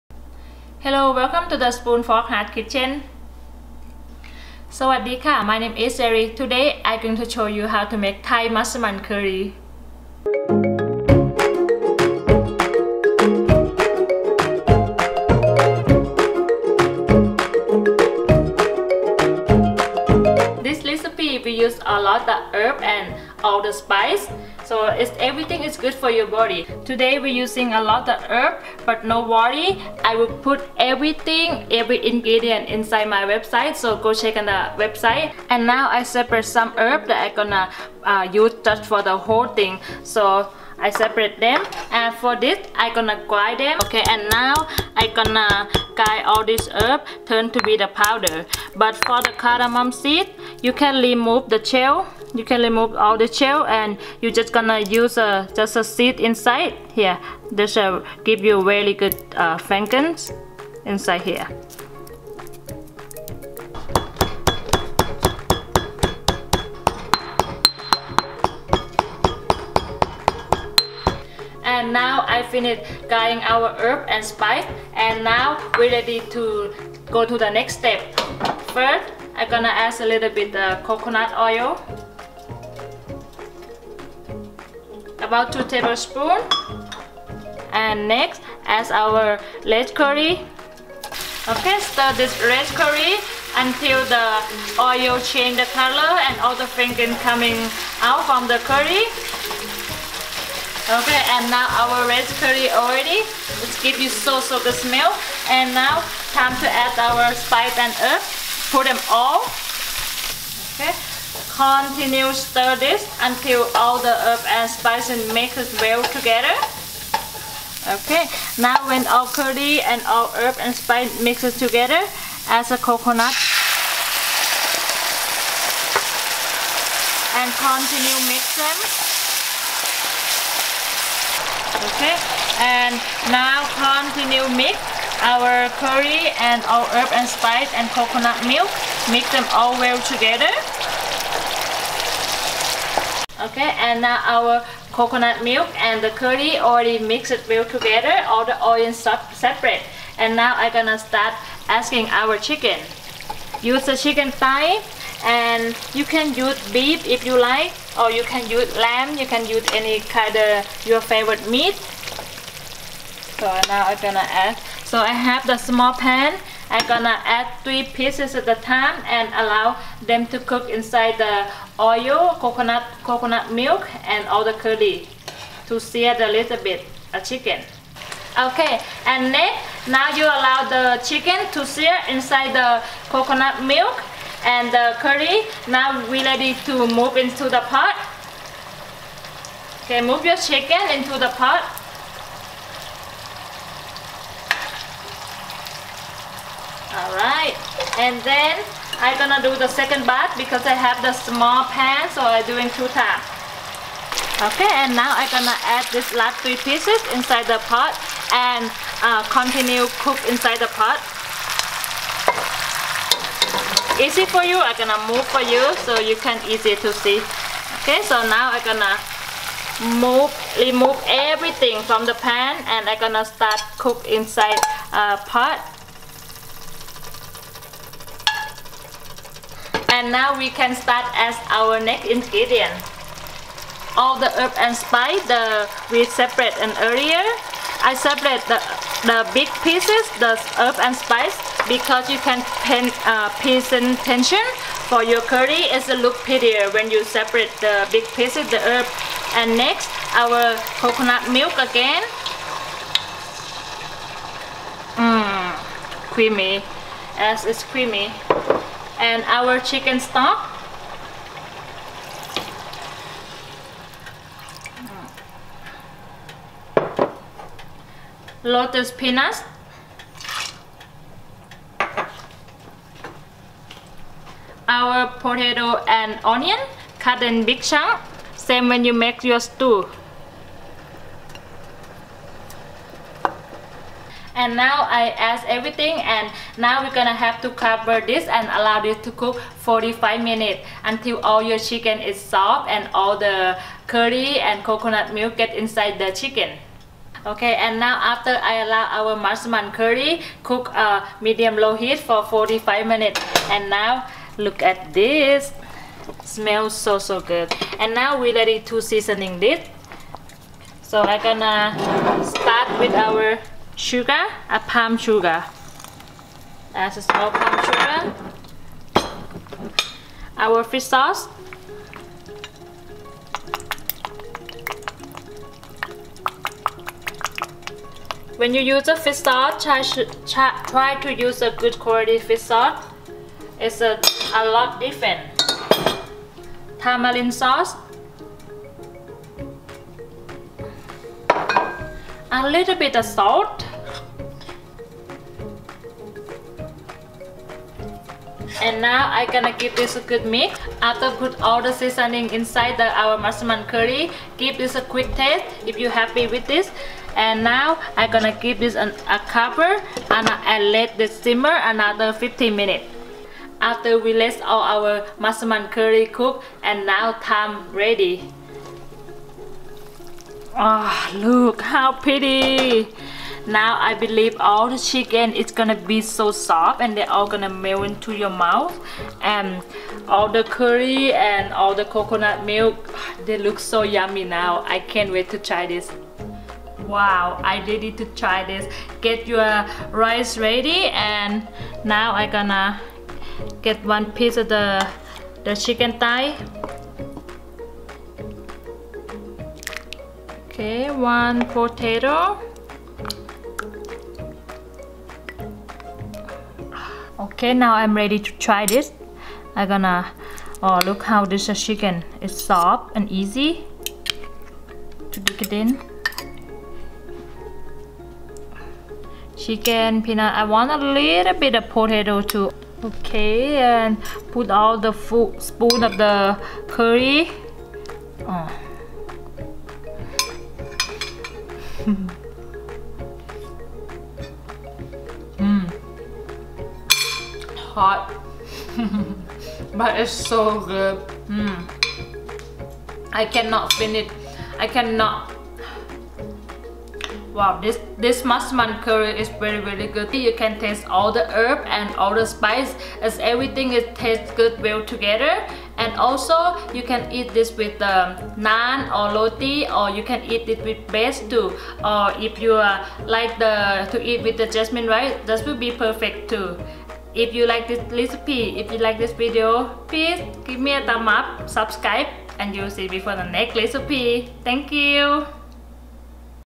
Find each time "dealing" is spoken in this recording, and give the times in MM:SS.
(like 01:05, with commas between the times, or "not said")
not said.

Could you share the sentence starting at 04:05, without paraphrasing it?
It's a look prettier when you separate the big pieces, the herb.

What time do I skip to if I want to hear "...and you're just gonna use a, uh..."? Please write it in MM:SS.
00:53.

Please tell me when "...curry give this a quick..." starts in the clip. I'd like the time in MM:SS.
05:53.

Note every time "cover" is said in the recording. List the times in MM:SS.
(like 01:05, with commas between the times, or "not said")
04:47, 05:59.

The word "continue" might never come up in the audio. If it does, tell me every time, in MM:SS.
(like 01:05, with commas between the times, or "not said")
01:51, 02:07, 02:13, 03:29.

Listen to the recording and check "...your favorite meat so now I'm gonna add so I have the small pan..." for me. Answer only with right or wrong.
right.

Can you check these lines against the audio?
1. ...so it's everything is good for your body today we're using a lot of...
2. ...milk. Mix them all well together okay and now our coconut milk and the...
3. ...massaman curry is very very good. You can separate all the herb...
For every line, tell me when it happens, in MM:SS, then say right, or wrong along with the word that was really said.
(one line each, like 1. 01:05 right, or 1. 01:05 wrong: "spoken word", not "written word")
1. 00:24 right
2. 02:18 right
3. 07:28 wrong: "taste", not "separate".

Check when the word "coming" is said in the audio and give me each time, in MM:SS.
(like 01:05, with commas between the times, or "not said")
01:37.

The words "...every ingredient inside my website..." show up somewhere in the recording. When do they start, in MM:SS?
00:31.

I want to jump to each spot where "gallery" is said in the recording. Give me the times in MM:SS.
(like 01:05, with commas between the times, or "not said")
not said.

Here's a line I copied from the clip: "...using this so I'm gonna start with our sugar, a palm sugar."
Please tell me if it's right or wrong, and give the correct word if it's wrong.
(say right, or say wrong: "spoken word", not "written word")
wrong: "seasoning", not "using".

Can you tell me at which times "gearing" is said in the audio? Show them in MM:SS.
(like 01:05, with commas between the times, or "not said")
not said.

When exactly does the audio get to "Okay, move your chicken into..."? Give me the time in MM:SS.
03:09.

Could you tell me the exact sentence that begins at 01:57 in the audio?
Okay, now when all curry and all herb and spice mixes together, add the coconut.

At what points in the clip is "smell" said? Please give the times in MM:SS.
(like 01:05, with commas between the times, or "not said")
01:44, 05:06.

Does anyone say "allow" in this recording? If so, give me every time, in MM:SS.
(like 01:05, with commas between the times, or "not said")
02:49, 03:00, 04:48, 04:58.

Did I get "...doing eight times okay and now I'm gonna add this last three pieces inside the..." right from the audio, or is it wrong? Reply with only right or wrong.
wrong.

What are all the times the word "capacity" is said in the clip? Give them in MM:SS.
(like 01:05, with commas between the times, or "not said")
not said.